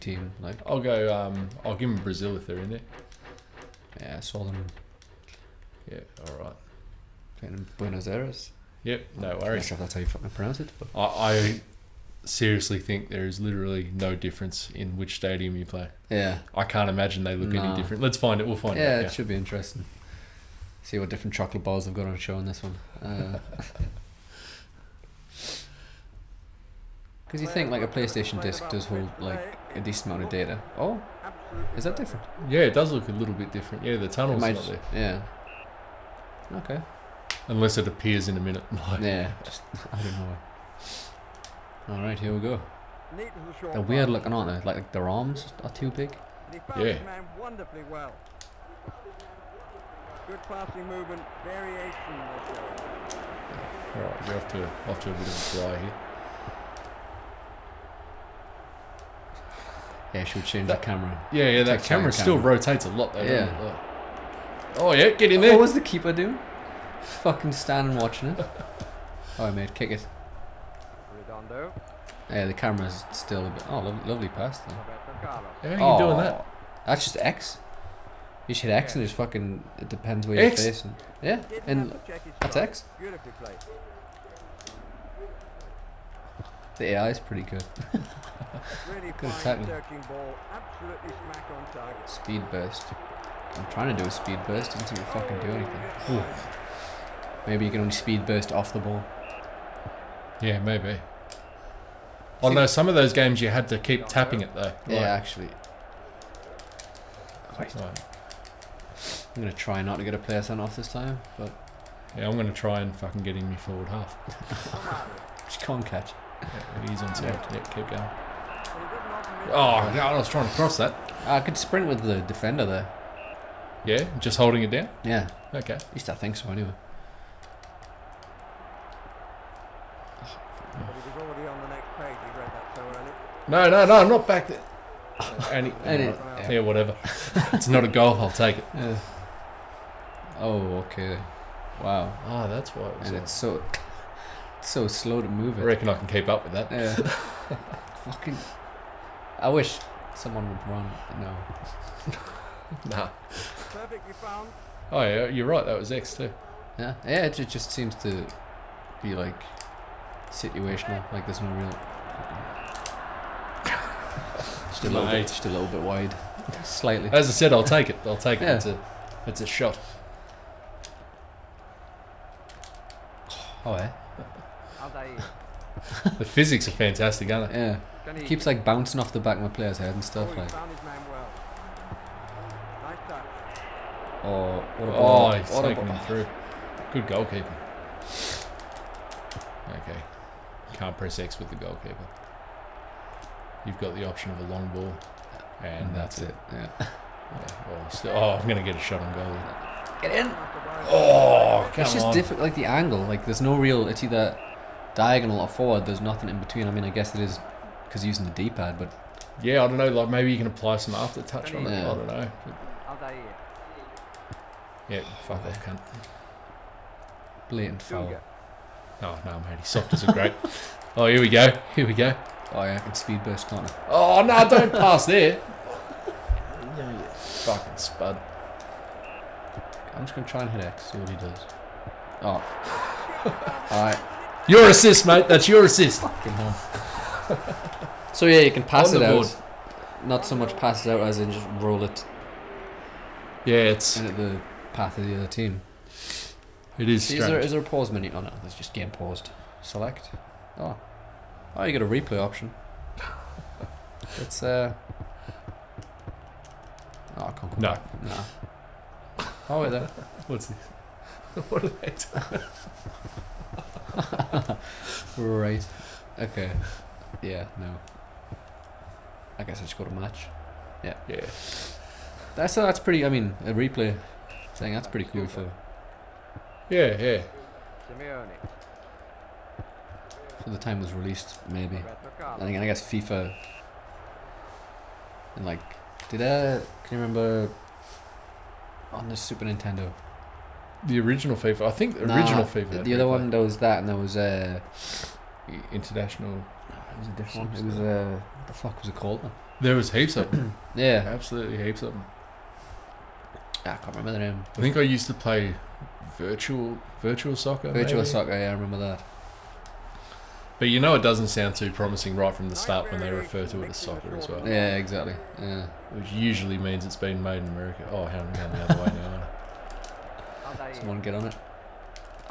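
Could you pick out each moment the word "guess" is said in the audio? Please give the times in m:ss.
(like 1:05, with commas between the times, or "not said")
3:26, 4:29, 4:42.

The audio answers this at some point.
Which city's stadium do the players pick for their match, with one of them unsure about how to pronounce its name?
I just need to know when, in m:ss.
0:07.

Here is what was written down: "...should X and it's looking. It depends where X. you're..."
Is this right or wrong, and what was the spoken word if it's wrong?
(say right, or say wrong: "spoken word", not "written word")
wrong: "fucking", not "looking".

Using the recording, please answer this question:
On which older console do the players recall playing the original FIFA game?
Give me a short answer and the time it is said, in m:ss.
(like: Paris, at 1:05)
Super Nintendo, at 4:49.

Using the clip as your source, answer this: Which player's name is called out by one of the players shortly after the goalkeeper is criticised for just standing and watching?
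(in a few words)
Redondo.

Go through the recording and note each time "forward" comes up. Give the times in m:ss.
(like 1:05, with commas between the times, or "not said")
1:53, 3:25.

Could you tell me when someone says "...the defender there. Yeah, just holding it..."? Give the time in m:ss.
2:02.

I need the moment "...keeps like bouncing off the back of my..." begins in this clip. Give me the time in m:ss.
2:58.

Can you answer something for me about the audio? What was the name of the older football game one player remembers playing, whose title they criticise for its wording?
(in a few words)
Virtual Soccer.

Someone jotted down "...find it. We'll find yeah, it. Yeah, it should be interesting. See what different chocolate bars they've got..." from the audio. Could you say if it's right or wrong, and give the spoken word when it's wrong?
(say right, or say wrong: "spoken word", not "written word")
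right.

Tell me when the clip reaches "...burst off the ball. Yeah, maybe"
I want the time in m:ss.
1:38.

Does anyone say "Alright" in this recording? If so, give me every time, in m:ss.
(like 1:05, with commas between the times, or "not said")
0:41, 0:53.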